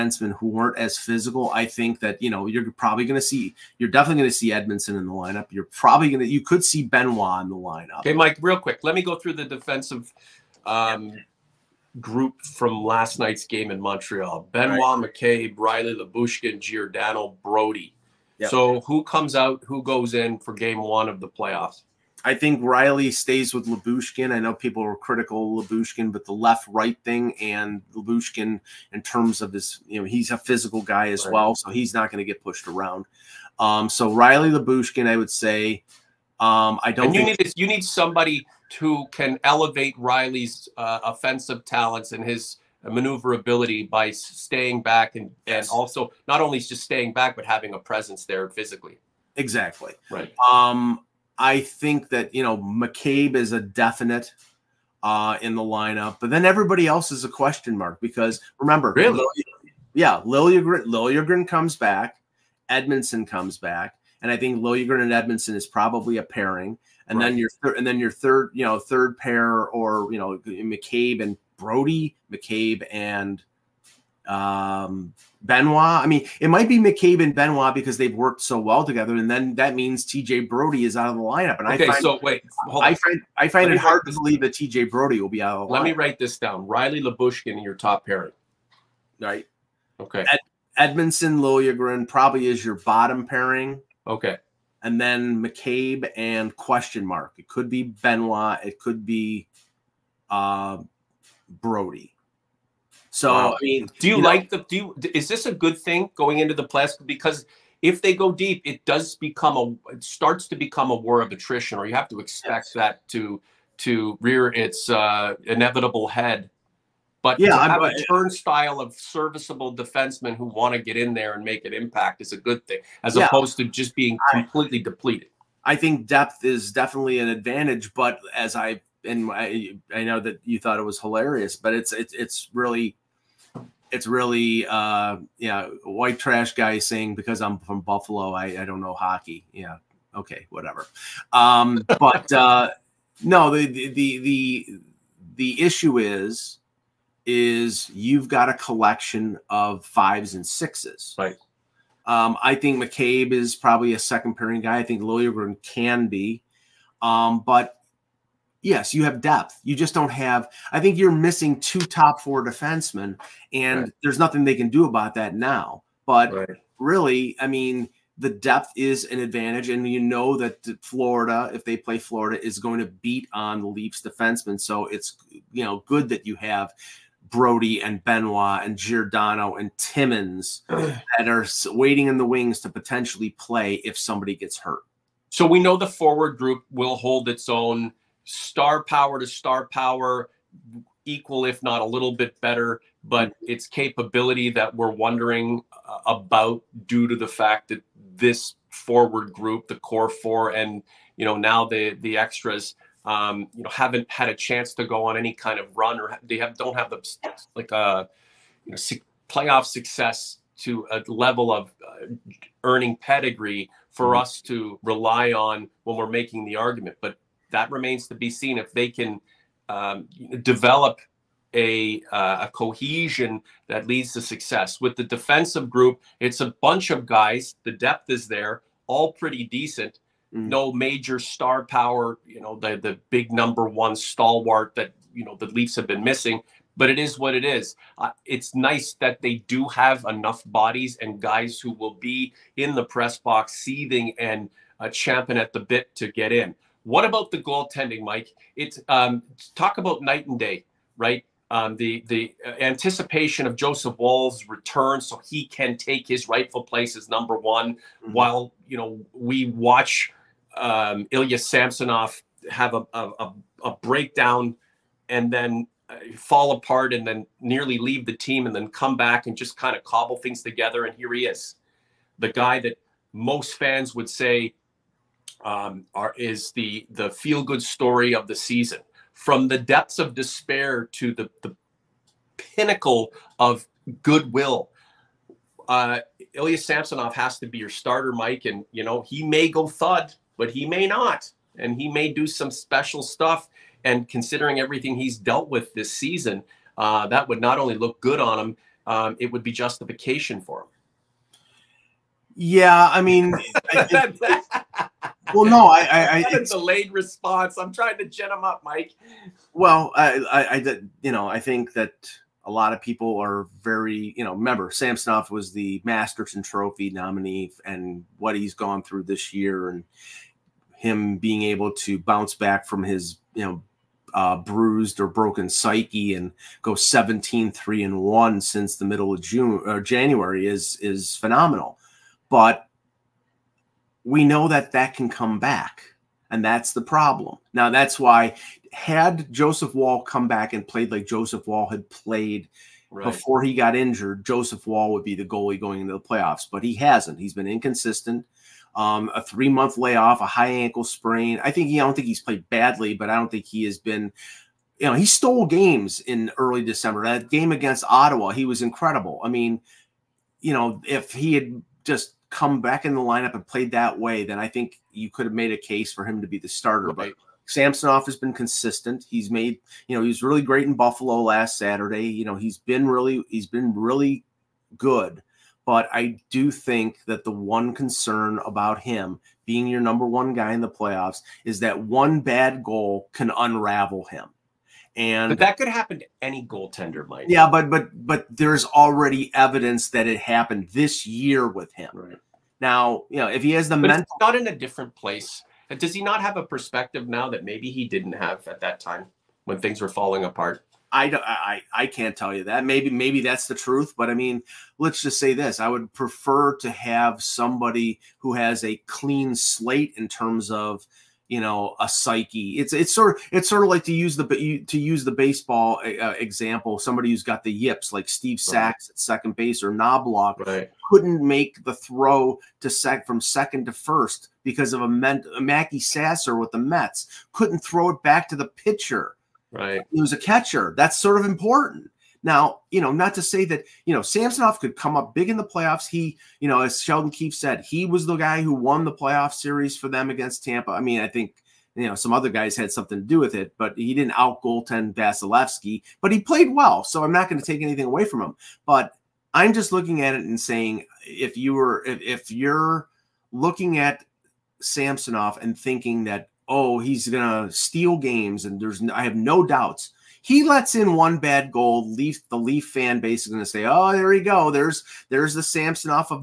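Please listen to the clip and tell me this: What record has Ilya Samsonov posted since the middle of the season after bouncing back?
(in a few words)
17-3-1.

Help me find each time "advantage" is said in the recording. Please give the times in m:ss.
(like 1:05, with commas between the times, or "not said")
2:07, 2:49.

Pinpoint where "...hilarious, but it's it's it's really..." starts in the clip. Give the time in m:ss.
2:10.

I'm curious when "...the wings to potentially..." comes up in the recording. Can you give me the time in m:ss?
3:02.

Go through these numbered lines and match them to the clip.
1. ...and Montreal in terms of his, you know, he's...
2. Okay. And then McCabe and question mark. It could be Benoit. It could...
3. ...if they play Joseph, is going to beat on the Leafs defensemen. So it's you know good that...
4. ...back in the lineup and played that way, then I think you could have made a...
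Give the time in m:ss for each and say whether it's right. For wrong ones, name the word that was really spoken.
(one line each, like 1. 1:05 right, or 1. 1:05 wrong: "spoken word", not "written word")
1. 0:27 wrong: "Lyubushkin", not "Montreal"
2. 1:34 right
3. 2:51 wrong: "Florida", not "Joseph"
4. 6:02 right.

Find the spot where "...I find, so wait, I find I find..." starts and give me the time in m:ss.
1:21.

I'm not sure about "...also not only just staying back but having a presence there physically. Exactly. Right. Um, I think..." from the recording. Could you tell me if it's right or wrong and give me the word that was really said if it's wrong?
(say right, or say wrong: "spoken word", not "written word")
right.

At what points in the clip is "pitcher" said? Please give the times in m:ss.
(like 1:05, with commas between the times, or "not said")
7:08.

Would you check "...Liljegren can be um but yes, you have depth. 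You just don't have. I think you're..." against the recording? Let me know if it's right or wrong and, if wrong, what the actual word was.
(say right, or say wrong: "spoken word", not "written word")
right.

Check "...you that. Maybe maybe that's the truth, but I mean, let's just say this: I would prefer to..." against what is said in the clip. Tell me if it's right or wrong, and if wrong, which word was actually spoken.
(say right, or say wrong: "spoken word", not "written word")
right.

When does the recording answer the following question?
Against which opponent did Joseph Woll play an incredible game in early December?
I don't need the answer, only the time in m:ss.
5:57.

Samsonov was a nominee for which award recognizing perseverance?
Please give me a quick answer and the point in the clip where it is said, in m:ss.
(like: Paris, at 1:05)
Masterton Trophy, at 5:15.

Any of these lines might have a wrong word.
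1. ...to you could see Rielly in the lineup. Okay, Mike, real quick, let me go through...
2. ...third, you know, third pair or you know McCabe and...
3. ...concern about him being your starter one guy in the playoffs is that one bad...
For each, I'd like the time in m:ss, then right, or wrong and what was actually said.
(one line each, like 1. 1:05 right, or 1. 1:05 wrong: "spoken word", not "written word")
1. 0:06 wrong: "Benoit", not "Rielly"
2. 1:08 right
3. 6:17 wrong: "number", not "starter".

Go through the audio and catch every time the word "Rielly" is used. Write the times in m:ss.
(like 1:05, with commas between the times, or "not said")
0:15, 0:22, 0:34, 0:39, 1:26.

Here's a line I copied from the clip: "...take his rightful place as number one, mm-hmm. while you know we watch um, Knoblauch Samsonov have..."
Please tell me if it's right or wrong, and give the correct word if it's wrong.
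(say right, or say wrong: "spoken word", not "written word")
wrong: "Ilya", not "Knoblauch".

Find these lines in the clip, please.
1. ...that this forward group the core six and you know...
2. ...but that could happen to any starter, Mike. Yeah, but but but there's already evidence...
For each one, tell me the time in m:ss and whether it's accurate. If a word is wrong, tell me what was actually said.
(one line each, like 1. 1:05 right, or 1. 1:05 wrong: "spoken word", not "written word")
1. 3:17 wrong: "four", not "six"
2. 6:25 wrong: "goaltender", not "starter".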